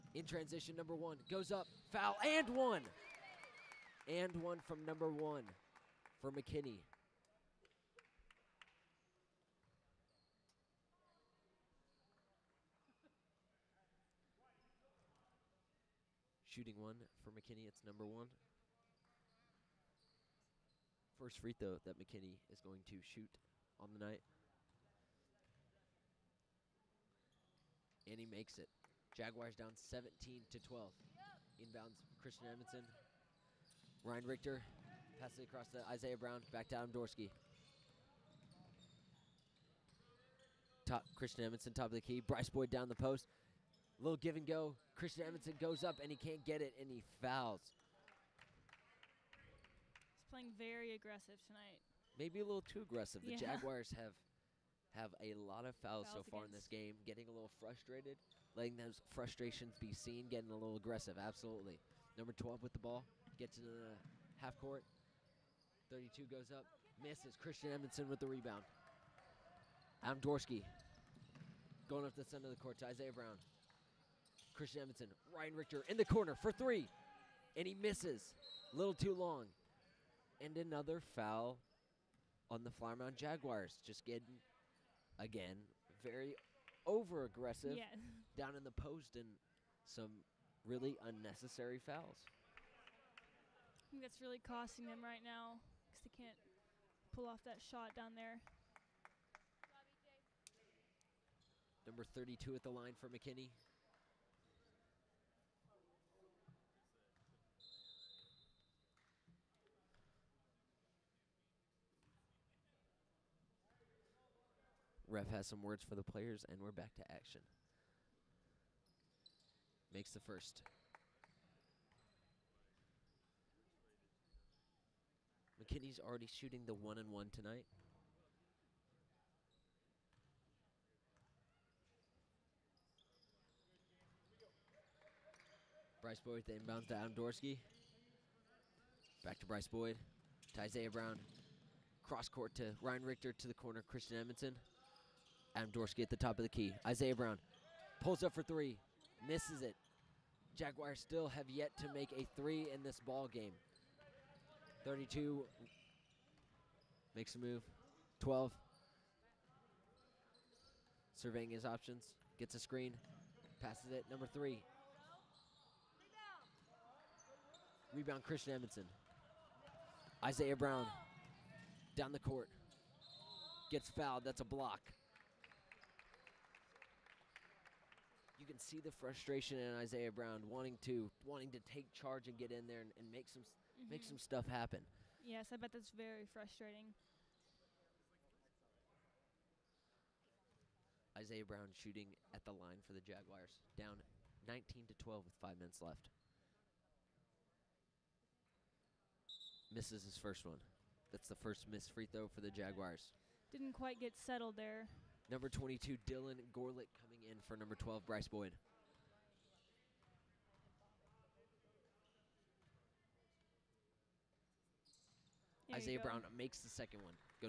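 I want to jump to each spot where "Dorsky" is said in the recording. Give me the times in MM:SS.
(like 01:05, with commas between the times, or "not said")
00:36, 01:10, 02:17, 02:25.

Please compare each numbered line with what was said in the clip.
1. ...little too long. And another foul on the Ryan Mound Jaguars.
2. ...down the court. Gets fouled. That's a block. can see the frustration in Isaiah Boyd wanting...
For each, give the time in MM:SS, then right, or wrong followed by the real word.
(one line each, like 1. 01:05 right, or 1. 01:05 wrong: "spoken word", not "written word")
1. 01:18 wrong: "Flower", not "Ryan"
2. 02:51 wrong: "Brown", not "Boyd".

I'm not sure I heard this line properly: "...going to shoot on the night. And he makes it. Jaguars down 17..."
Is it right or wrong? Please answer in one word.
right.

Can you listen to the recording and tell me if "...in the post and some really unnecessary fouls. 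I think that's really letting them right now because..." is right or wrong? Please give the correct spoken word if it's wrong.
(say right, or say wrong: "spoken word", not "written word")
wrong: "costing", not "letting".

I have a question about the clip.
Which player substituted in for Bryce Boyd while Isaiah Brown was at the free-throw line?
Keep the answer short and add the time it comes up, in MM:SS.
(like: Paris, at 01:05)
Dylan Gorlick, at 03:26.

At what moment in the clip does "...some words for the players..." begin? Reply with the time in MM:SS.
01:55.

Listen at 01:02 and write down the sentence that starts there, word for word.
Number 12 with the ball, gets into the half court, 32 goes up, misses.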